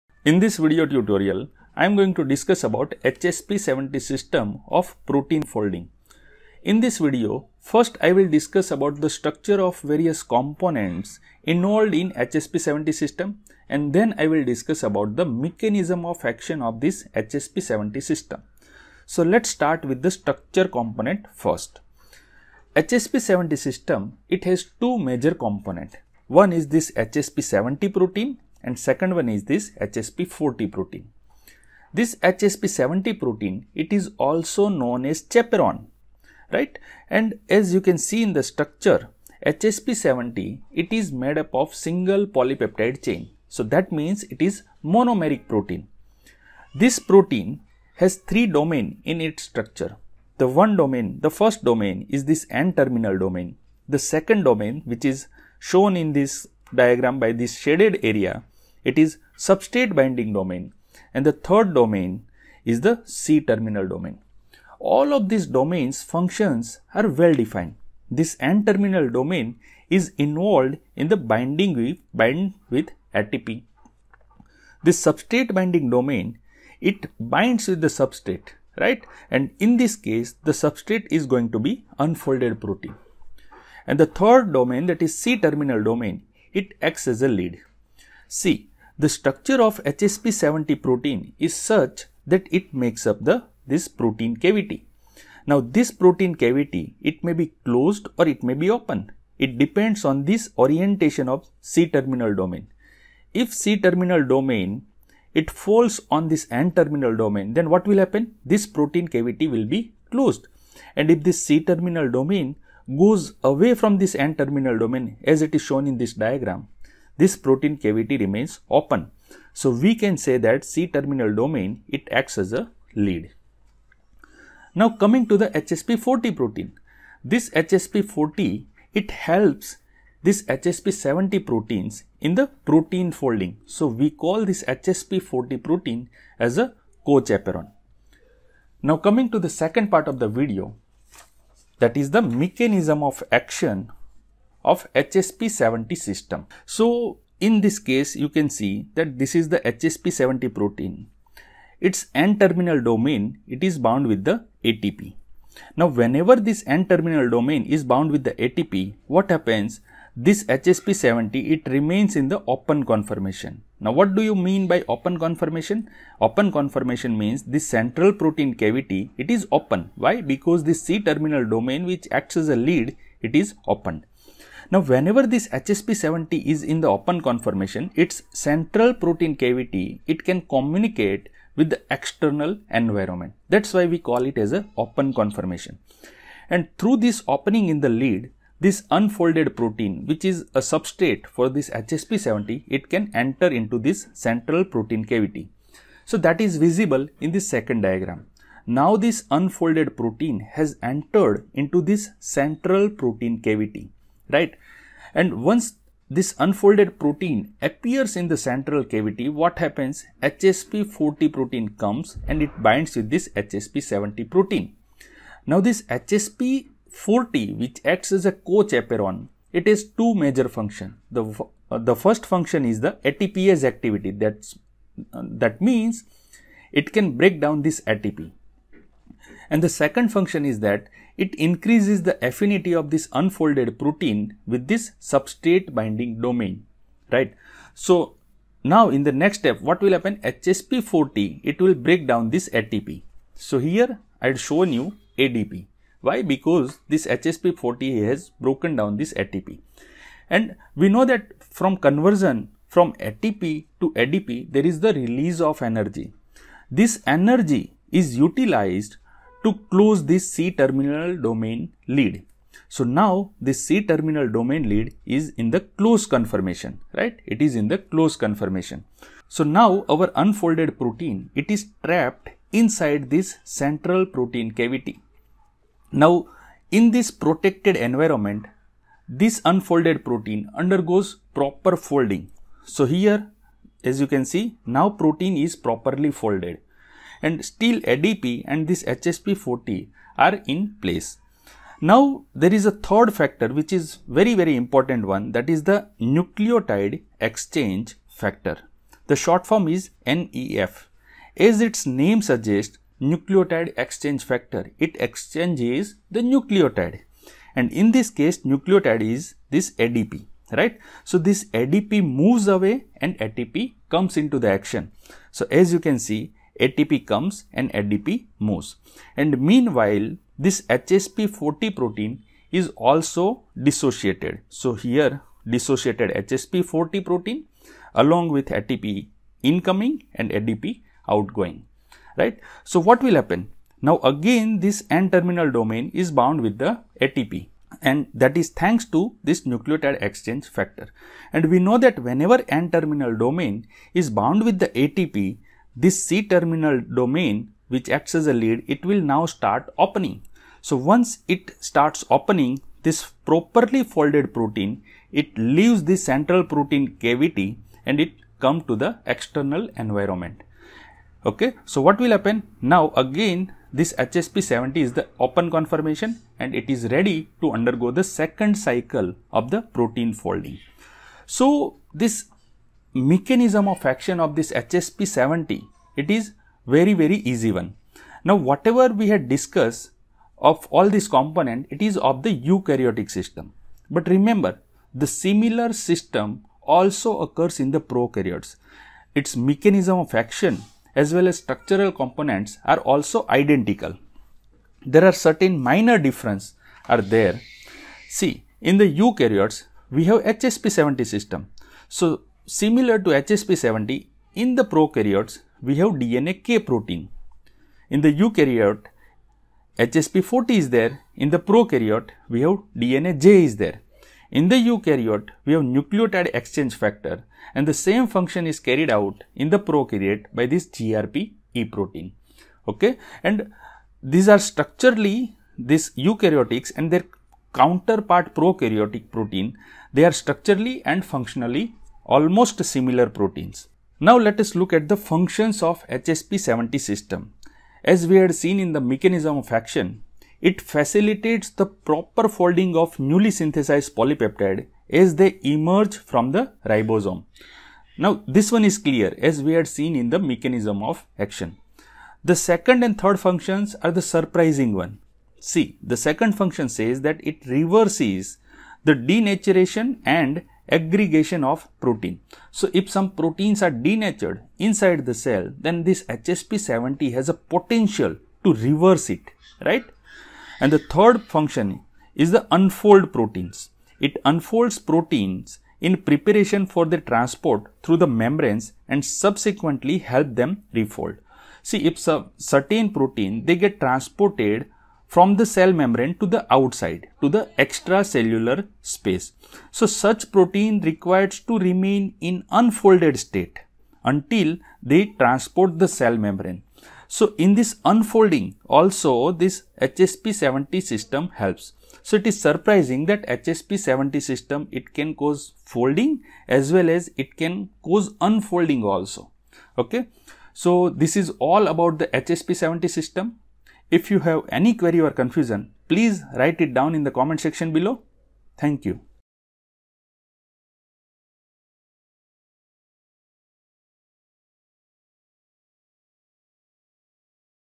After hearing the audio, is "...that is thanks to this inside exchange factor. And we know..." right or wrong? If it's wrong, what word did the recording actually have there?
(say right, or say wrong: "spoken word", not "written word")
wrong: "nucleotide", not "inside".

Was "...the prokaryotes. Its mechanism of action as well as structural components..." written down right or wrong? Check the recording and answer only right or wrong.
right.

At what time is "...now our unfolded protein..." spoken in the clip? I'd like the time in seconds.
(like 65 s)
269 s.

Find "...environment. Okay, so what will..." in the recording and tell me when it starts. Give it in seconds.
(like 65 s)
359 s.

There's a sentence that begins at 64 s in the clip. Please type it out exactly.
All of these domains functions are well defined.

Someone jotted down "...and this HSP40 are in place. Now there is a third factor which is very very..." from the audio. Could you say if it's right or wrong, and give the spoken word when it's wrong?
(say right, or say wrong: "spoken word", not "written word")
right.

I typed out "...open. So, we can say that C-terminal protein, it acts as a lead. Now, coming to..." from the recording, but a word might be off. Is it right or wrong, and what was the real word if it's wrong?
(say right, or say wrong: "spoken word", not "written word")
wrong: "domain", not "protein".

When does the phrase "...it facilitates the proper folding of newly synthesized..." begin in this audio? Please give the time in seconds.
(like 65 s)
440 s.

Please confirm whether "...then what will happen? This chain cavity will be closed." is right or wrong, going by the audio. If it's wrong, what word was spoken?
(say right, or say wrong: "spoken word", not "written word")
wrong: "protein", not "chain".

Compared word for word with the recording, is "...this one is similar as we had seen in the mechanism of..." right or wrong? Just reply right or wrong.
wrong.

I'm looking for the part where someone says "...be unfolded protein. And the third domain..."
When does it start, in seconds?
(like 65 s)
81 s.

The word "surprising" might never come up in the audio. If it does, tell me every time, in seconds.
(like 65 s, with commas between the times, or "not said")
454 s, 502 s.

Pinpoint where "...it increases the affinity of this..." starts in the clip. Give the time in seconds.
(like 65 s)
231 s.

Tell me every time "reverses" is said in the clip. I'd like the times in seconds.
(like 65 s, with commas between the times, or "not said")
457 s, 468 s.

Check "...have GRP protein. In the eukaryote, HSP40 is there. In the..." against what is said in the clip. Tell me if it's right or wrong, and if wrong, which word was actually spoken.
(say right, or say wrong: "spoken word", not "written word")
wrong: "DnaK", not "GRP".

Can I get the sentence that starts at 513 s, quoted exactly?
If you have any query or confusion, please write it down in the comment section below.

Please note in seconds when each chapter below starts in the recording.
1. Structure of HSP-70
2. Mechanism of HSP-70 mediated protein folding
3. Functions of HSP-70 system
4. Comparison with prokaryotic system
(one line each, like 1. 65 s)
1. 23 s
2. 142 s
3. 434 s
4. 378 s.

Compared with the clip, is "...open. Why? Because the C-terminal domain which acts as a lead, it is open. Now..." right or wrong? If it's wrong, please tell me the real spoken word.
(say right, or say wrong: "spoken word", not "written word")
right.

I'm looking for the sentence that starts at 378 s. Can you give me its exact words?
Now, whatever we had discussed of all these component, it is of the eukaryotic system.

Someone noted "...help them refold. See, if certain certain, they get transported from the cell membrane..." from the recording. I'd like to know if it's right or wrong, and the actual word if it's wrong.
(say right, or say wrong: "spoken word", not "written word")
wrong: "protein", not "certain".